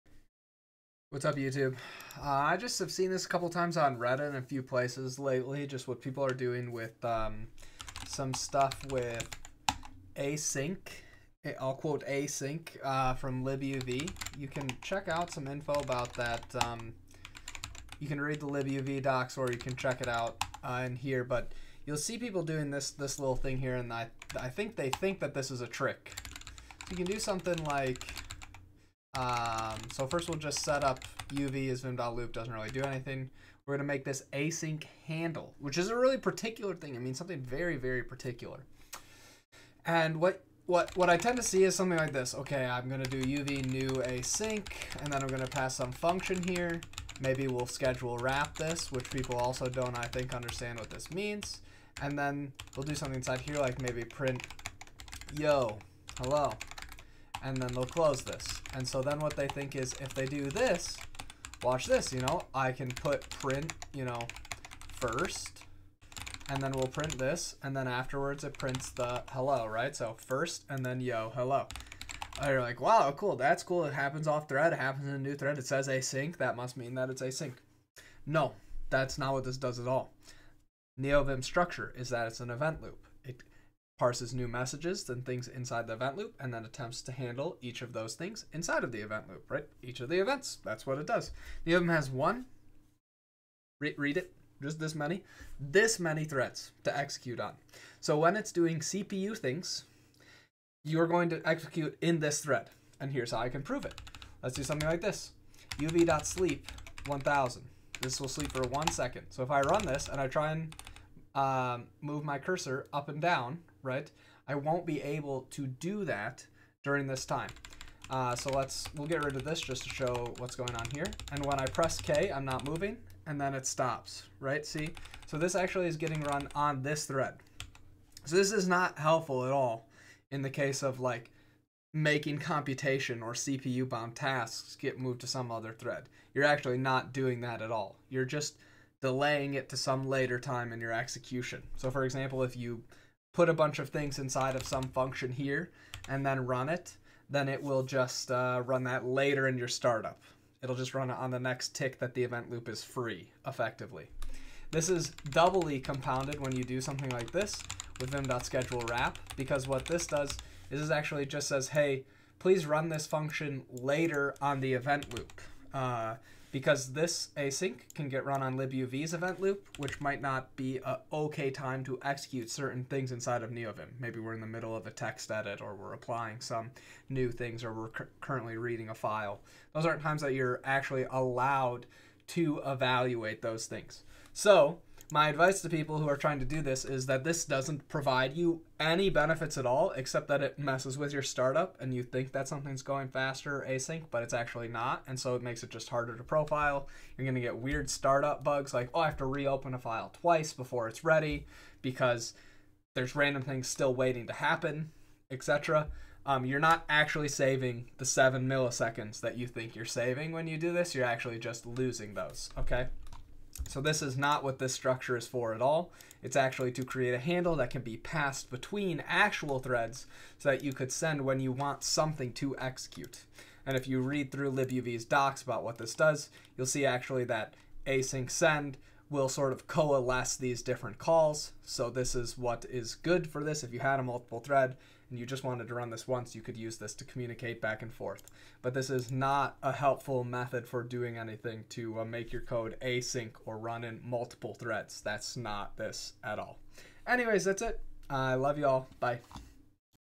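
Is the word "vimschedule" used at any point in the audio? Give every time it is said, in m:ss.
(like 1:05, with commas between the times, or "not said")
2:38.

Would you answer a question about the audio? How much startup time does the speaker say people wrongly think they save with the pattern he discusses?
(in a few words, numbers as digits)
7 milliseconds.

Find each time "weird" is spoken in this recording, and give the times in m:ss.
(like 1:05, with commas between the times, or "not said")
3:17.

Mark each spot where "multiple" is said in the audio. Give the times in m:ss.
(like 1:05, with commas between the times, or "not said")
3:54, 4:04.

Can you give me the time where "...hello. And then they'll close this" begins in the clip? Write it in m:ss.
0:56.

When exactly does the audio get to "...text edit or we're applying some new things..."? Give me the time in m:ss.
2:54.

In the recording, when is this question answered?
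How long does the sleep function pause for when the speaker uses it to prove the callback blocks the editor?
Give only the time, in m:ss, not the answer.
1:48.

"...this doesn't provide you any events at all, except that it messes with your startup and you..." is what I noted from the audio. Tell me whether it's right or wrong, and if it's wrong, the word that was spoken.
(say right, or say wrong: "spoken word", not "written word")
wrong: "benefits", not "events".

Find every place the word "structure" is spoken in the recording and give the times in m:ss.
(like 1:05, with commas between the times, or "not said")
1:21, 3:34.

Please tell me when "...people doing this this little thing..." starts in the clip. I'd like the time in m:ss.
0:22.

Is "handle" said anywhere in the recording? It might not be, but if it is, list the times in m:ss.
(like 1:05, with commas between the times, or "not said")
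0:35, 1:27, 3:37.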